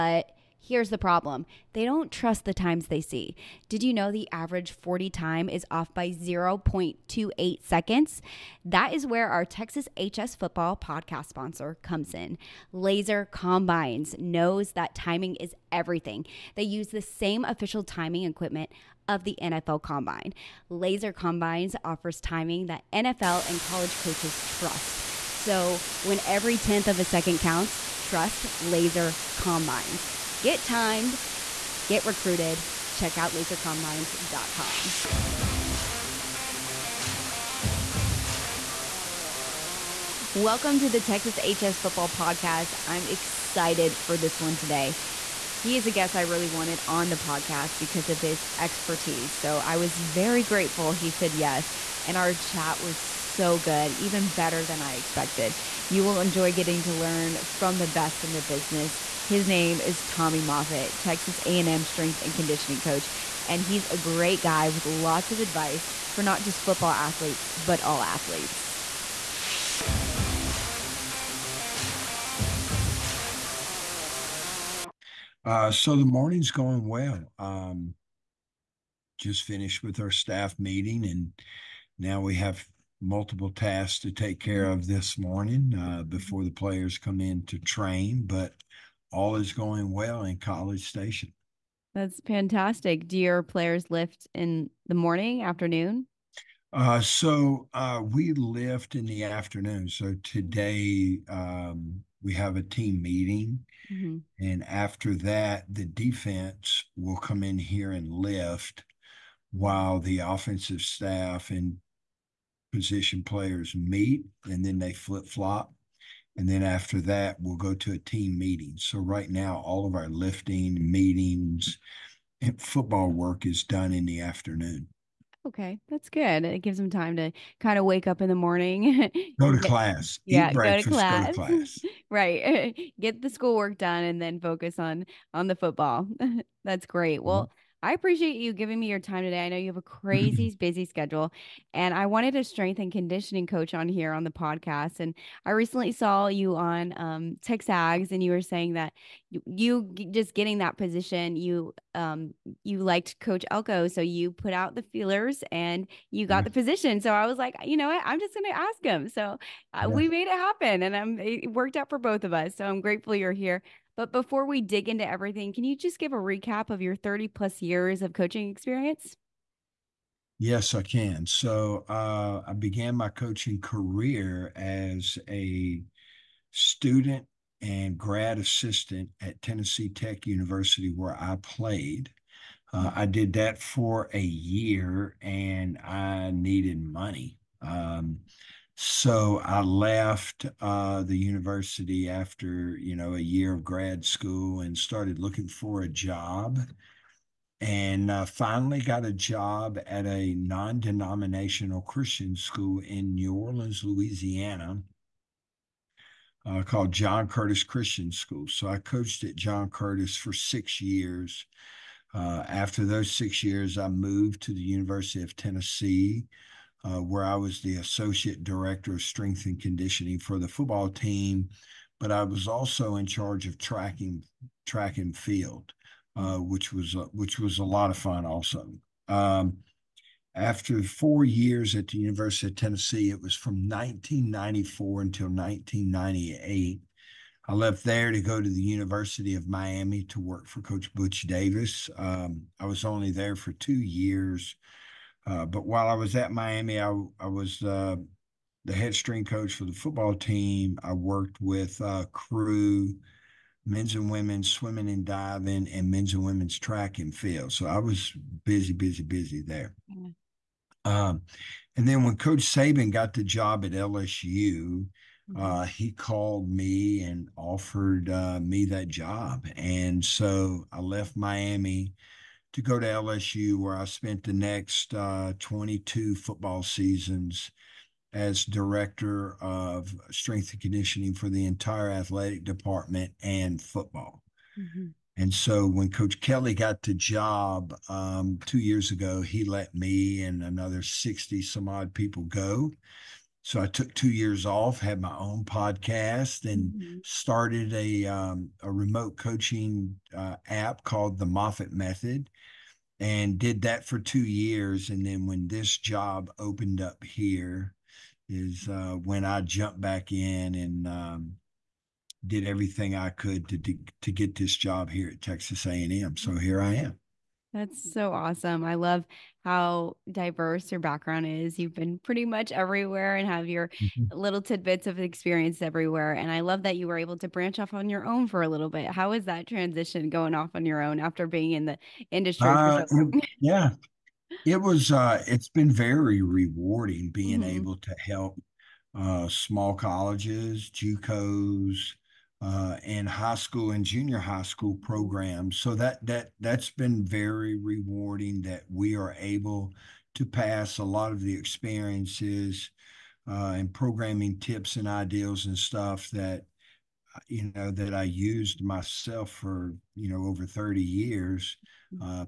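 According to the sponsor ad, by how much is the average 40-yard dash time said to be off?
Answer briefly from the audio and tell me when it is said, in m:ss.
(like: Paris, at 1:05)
0.28 seconds, at 0:06.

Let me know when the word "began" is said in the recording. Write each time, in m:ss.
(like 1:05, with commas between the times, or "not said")
2:52.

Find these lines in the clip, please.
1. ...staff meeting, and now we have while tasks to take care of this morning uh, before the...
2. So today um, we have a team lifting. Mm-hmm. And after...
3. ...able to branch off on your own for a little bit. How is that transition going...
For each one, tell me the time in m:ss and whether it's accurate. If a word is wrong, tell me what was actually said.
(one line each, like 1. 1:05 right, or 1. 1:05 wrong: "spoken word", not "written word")
1. 1:20 wrong: "multiple", not "while"
2. 1:39 wrong: "meeting", not "lifting"
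3. 5:26 right.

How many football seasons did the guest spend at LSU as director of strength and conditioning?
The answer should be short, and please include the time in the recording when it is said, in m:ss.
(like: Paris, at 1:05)
22, at 4:35.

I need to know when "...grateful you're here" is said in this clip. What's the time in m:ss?
2:42.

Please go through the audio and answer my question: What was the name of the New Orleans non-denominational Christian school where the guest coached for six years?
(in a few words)
John Curtis Christian School.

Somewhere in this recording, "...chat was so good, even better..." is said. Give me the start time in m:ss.
0:52.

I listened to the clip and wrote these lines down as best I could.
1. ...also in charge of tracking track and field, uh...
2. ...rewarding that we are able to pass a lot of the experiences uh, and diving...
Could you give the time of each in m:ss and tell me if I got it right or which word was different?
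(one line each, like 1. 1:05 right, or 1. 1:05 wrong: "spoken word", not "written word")
1. 3:42 right
2. 5:47 wrong: "programming", not "diving".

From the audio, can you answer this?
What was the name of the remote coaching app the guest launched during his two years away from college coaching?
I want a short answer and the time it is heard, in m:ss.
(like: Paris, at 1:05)
the Moffitt Method, at 5:01.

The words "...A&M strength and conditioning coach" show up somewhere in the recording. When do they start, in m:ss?
1:01.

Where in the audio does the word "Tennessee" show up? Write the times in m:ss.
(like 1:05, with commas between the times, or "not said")
2:59, 3:35, 3:52.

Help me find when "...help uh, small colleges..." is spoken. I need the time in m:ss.
5:38.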